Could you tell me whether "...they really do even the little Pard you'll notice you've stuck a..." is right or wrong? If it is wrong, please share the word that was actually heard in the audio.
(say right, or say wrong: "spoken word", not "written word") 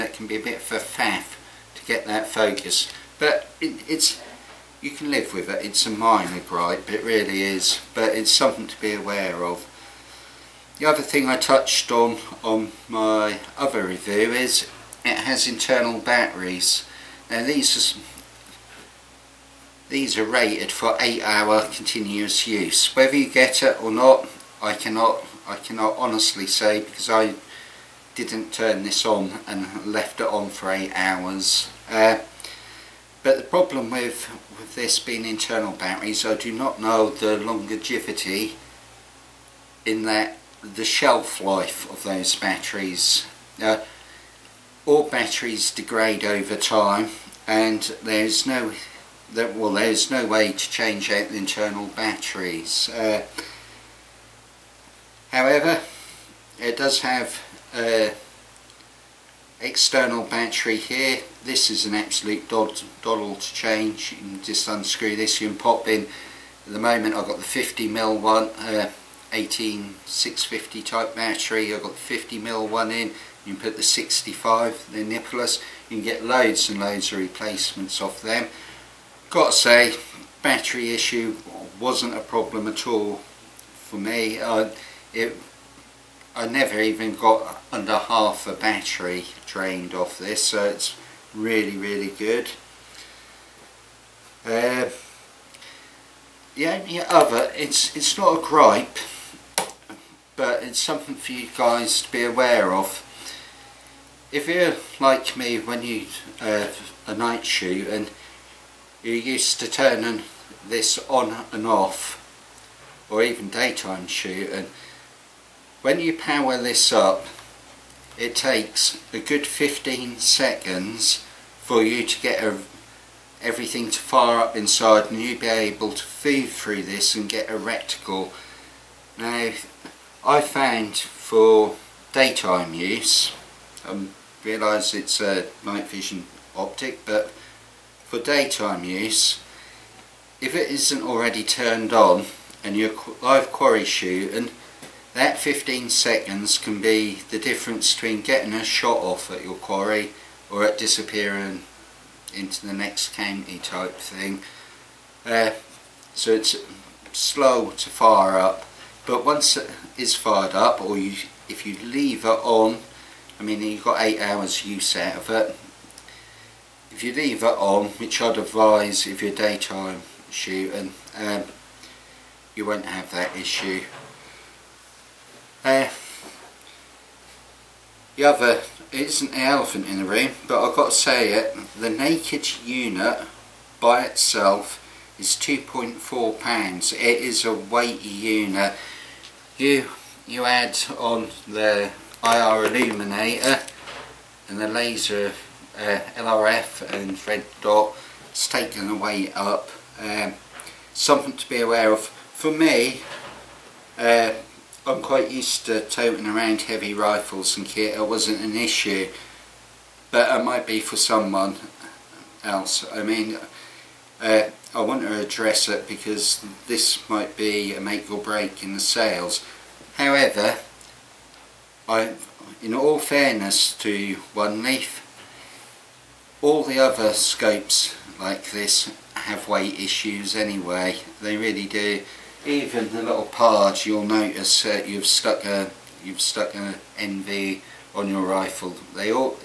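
right.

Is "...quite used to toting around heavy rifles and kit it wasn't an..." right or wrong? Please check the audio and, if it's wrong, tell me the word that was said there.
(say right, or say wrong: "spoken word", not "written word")
right.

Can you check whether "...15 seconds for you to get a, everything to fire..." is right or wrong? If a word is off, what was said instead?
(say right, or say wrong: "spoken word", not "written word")
right.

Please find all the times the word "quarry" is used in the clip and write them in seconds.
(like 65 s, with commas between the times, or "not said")
143 s, 149 s.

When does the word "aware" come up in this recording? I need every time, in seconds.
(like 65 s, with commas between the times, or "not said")
8 s, 102 s, 201 s.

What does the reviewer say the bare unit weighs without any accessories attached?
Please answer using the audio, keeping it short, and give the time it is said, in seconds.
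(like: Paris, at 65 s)
2.4 pounds, at 185 s.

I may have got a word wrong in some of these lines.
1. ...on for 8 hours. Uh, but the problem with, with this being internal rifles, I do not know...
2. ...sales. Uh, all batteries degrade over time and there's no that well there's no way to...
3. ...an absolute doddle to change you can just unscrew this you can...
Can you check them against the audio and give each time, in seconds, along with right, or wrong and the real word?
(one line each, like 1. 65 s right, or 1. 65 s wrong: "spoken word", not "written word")
1. 30 s wrong: "batteries", not "rifles"
2. 42 s wrong: "batteries", not "sales"
3. 61 s right.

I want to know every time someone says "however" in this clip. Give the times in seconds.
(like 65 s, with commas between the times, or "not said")
55 s, 219 s.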